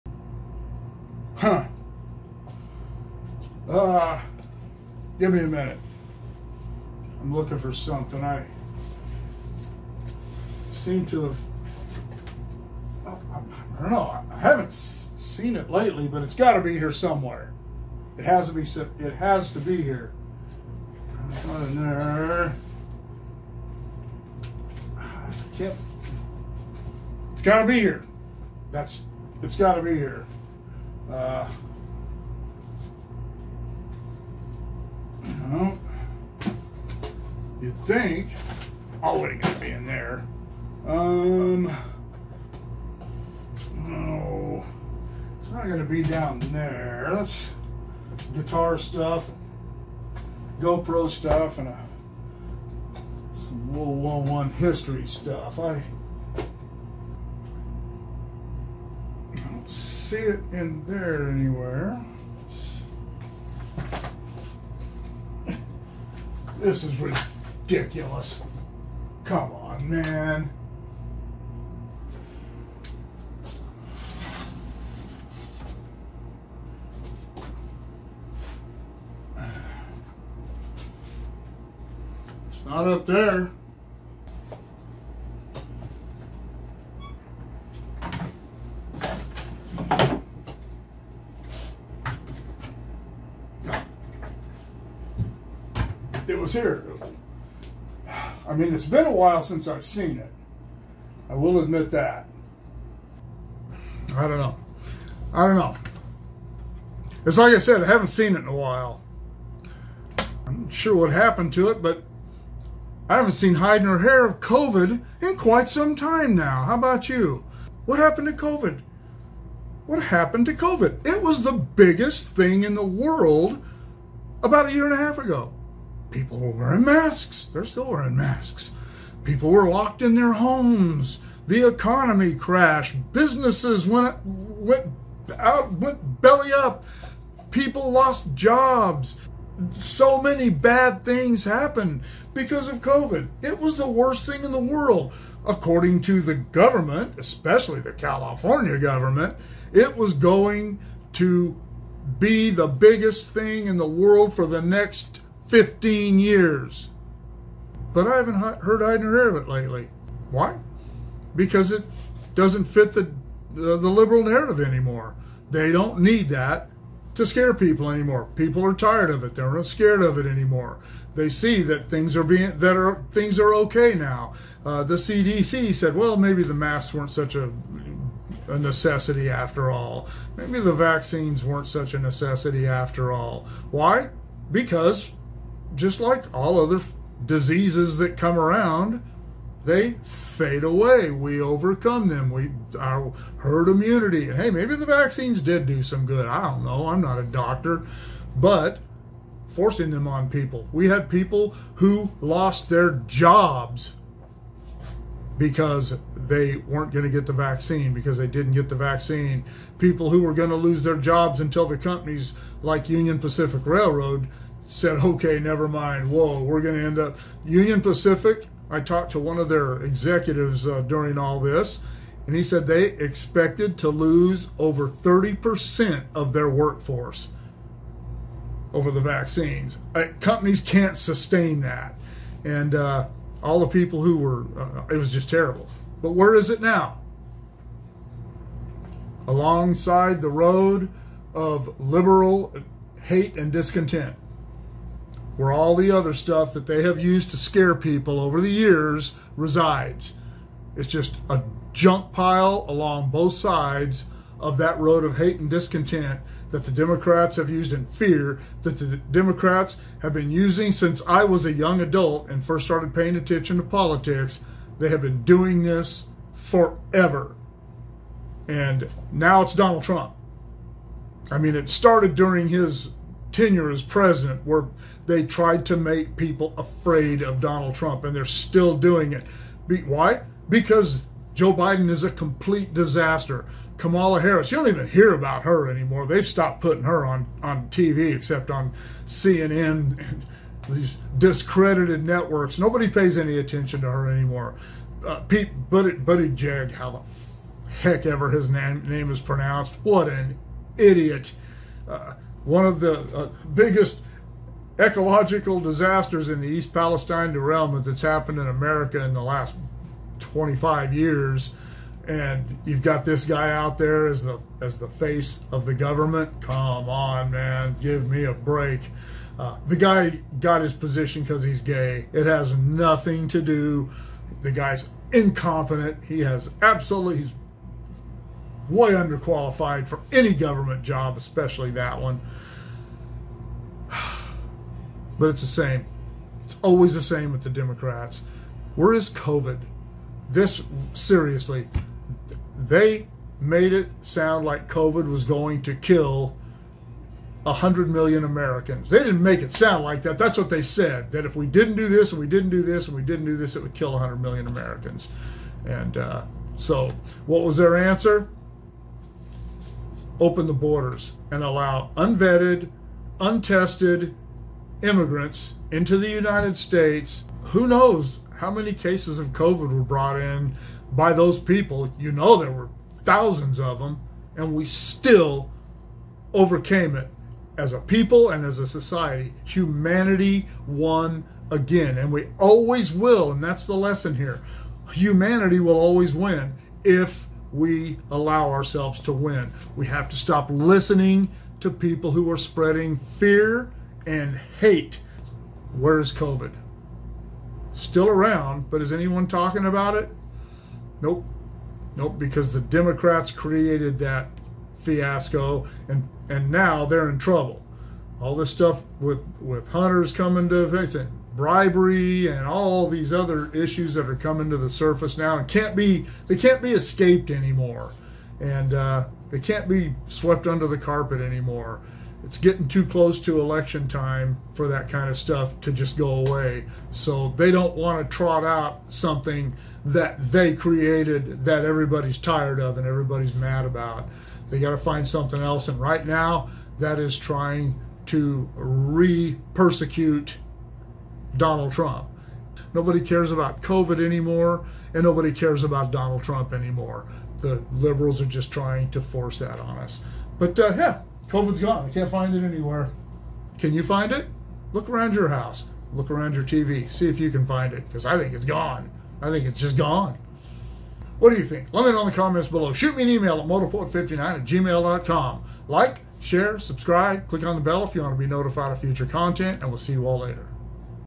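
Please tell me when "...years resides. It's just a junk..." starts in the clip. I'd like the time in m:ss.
4:08.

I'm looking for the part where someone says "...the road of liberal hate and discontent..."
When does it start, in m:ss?
4:00.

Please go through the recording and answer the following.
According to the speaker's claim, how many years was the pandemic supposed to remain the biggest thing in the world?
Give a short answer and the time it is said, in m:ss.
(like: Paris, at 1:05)
15, at 2:35.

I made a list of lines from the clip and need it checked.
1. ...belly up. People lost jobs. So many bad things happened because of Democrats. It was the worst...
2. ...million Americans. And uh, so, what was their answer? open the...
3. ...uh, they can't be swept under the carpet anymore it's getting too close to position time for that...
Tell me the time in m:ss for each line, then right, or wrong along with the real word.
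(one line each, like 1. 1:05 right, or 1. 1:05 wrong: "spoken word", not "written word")
1. 2:16 wrong: "COVID", not "Democrats"
2. 5:54 right
3. 6:58 wrong: "election", not "position".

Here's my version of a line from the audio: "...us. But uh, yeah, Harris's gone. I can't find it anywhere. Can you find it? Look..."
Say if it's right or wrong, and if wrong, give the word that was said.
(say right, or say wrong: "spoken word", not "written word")
wrong: "COVID", not "Harris".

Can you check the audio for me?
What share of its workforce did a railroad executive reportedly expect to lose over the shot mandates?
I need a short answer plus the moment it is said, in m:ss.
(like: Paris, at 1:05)
Over 30%, at 3:44.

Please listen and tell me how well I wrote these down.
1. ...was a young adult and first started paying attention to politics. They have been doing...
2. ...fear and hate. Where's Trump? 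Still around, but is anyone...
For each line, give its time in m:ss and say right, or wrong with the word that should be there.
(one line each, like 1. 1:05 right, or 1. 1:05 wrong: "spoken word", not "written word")
1. 4:21 right
2. 6:33 wrong: "COVID", not "Trump".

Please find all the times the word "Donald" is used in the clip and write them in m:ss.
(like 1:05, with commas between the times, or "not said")
4:29, 4:37, 7:21, 7:25.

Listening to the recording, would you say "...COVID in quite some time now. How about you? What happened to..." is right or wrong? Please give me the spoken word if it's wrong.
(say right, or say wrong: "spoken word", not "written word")
right.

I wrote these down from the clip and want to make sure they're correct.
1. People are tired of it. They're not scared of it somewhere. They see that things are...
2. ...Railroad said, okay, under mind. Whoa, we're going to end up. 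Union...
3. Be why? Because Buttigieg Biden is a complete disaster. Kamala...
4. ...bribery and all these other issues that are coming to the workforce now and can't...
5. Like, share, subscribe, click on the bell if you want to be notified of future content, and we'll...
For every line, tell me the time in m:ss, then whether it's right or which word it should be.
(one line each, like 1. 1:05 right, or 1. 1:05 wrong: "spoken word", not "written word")
1. 2:48 wrong: "anymore", not "somewhere"
2. 3:33 wrong: "never", not "under"
3. 4:39 wrong: "Joe", not "Buttigieg"
4. 6:51 wrong: "surface", not "workforce"
5. 7:45 right.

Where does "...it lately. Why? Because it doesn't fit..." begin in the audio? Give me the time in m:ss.
2:39.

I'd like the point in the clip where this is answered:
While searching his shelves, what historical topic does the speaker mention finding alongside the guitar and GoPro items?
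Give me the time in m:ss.
0:53.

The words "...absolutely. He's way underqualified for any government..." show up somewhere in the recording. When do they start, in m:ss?
5:26.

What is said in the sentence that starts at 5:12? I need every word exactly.
And you've got this guy out there as the as the face of the government.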